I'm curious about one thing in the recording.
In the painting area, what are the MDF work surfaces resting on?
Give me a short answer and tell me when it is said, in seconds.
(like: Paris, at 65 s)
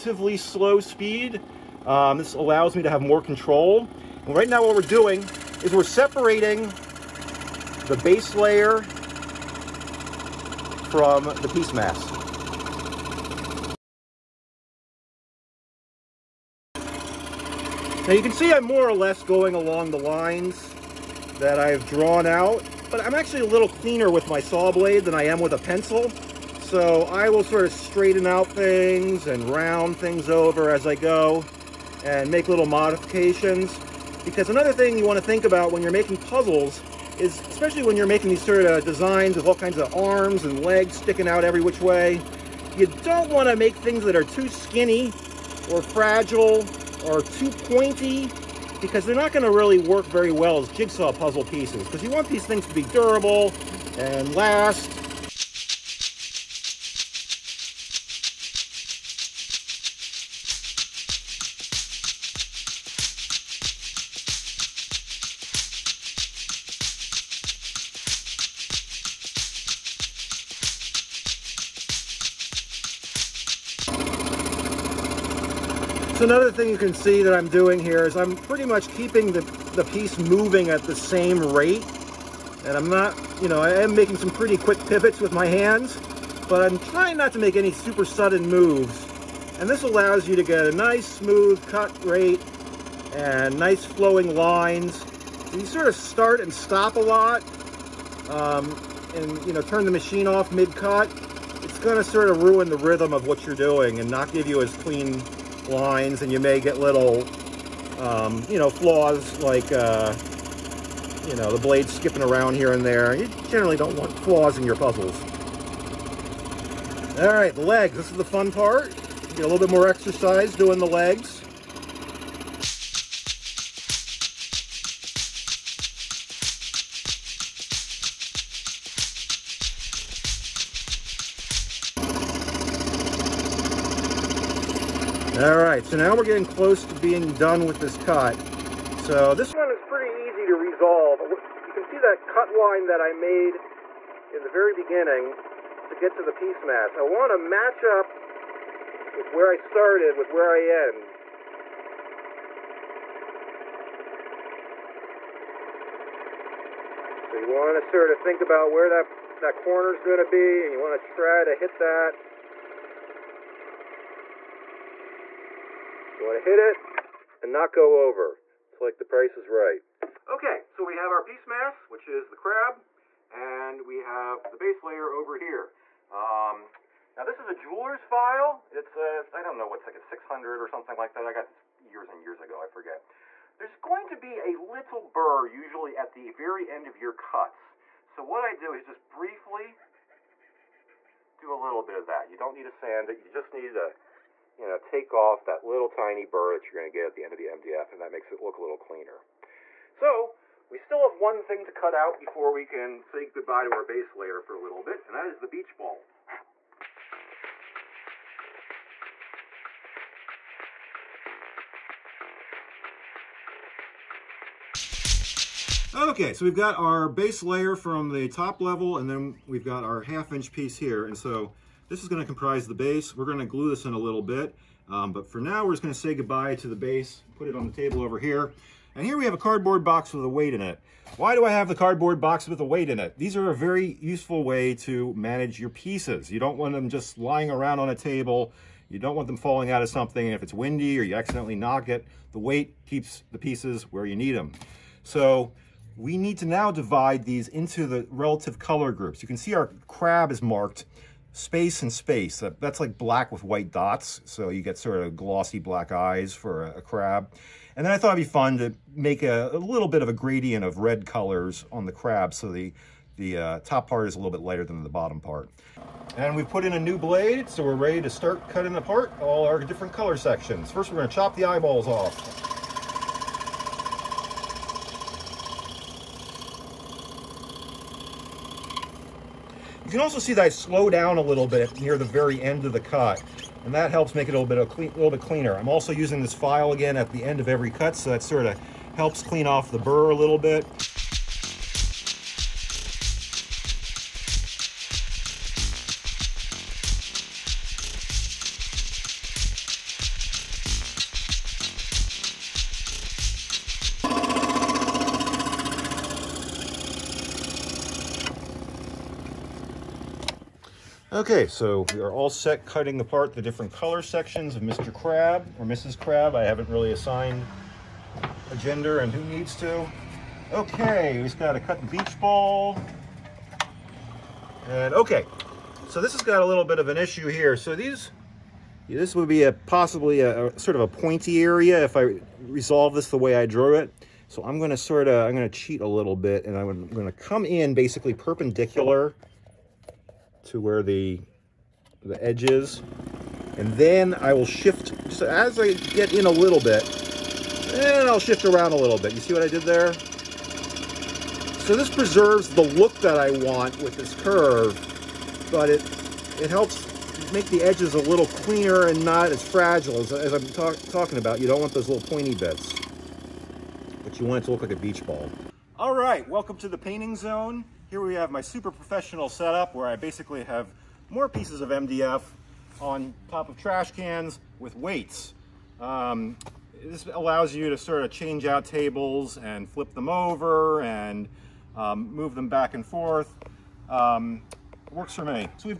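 trash cans, at 373 s.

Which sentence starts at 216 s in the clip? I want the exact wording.
Okay, so we've got our base layer from the top level, and then we've got our half inch piece here.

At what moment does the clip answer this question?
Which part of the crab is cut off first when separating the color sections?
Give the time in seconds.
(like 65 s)
271 s.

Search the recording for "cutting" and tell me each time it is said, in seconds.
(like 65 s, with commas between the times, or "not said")
268 s, 312 s.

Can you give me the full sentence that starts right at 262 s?
So the, the uh, top part is a little bit lighter than the bottom part.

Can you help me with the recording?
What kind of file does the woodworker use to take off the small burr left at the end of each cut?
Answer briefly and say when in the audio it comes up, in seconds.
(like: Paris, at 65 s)
jeweler's file, at 177 s.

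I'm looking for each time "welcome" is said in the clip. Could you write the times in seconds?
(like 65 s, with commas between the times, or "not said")
366 s.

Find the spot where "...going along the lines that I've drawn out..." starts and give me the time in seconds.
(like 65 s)
19 s.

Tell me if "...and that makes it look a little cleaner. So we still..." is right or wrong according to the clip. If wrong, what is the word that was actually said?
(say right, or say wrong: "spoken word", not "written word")
right.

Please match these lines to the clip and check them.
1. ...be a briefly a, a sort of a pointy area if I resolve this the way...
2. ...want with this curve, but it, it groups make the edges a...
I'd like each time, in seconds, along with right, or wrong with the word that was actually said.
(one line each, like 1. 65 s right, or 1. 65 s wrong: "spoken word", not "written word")
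1. 329 s wrong: "possibly", not "briefly"
2. 353 s wrong: "helps", not "groups".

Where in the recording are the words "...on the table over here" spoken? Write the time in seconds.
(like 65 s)
227 s.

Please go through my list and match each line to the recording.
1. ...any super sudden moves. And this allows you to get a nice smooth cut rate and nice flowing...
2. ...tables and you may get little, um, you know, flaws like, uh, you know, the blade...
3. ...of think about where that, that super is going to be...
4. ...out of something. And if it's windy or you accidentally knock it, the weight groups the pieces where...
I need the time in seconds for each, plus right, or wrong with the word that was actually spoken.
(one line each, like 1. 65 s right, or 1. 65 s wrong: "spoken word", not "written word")
1. 87 s right
2. 105 s wrong: "lines", not "tables"
3. 158 s wrong: "corner", not "super"
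4. 239 s wrong: "keeps", not "groups".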